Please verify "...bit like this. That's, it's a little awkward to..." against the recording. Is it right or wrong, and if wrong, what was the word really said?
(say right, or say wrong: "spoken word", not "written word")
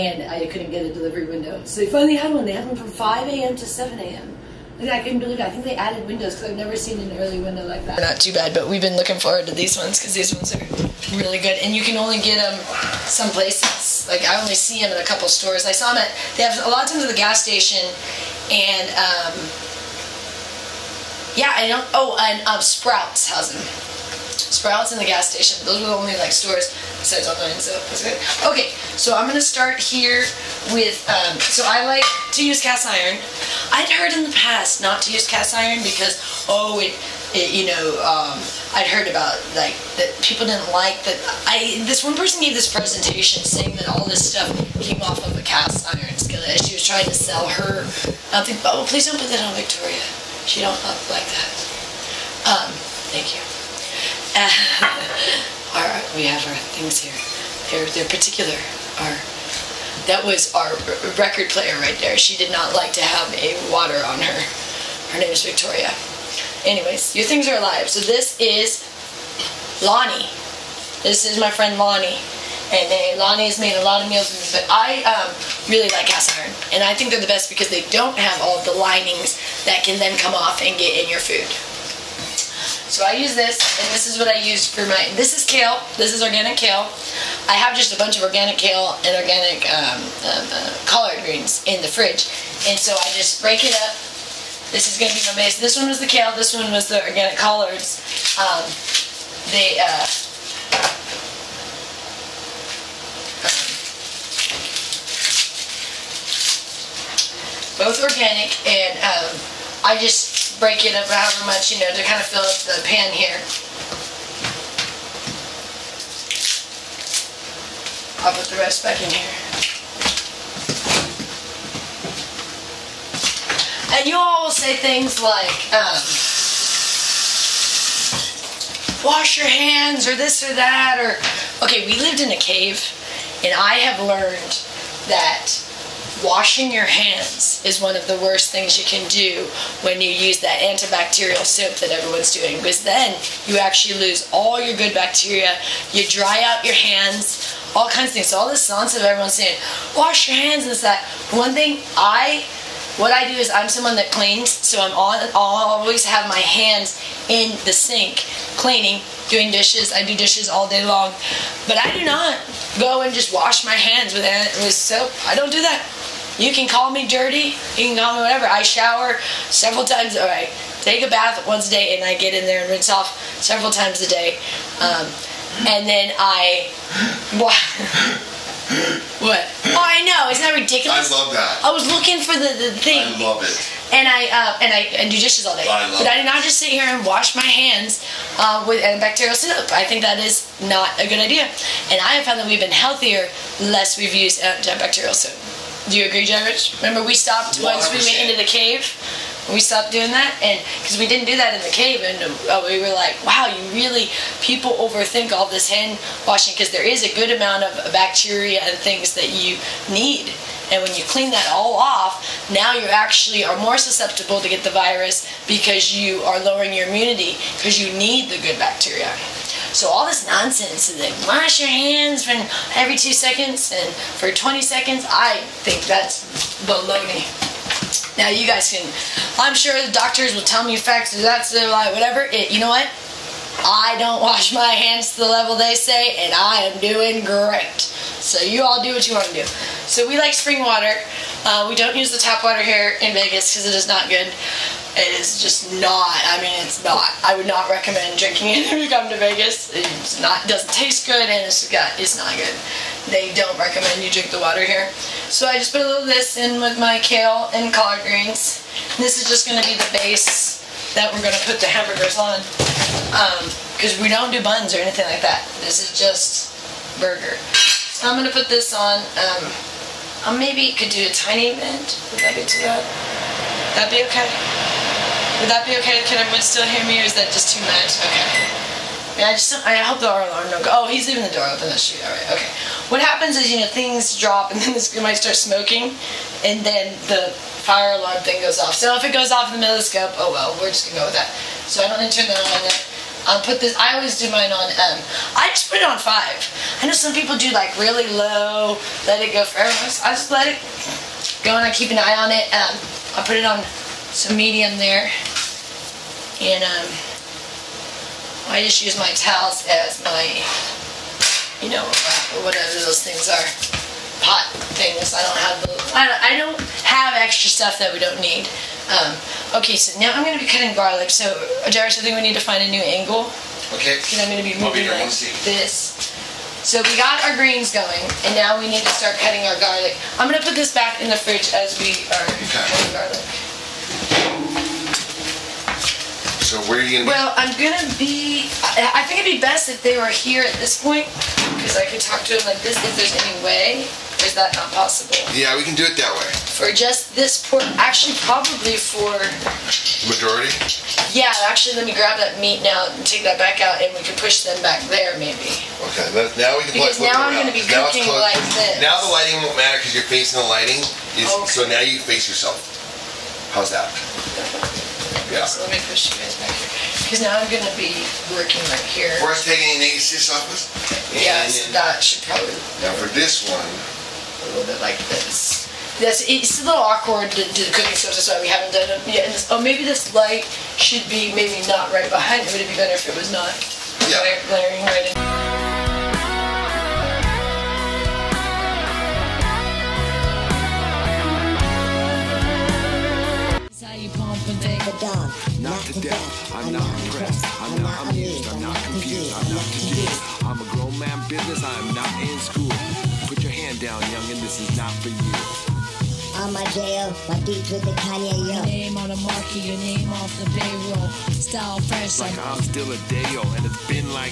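right.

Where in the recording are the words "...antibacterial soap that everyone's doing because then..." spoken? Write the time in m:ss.
2:20.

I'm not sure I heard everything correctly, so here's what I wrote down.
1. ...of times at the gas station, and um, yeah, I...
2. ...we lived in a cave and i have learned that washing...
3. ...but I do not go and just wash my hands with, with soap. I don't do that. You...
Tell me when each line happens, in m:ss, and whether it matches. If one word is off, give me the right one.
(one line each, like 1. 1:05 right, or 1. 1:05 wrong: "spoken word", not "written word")
1. 0:16 right
2. 2:11 right
3. 2:41 right.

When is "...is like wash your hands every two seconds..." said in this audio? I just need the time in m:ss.
3:40.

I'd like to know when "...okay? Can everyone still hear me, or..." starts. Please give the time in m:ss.
4:35.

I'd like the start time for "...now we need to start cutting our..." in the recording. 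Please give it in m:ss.
5:28.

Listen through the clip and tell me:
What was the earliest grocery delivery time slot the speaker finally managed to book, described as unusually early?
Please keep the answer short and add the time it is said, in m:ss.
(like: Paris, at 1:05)
5 a.m. to 7 a.m., at 0:02.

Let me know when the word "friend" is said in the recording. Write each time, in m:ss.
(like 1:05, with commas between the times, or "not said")
1:11.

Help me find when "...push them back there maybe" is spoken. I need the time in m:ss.
5:54.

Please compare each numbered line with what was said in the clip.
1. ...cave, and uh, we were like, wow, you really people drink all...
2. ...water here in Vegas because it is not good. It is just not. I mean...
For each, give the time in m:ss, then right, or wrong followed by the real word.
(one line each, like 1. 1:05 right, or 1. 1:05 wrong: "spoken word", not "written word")
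1. 3:21 wrong: "overthink", not "drink"
2. 4:02 right.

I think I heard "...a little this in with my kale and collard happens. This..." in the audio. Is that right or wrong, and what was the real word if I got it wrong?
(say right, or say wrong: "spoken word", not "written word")
wrong: "greens", not "happens".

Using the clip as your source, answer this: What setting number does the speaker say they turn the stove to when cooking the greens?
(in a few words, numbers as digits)
5.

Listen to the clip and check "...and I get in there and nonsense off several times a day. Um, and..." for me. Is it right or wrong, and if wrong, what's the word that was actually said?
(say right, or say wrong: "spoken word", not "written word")
wrong: "rinse", not "nonsense".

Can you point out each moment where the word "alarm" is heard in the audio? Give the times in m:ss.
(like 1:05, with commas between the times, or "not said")
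4:40, 4:48.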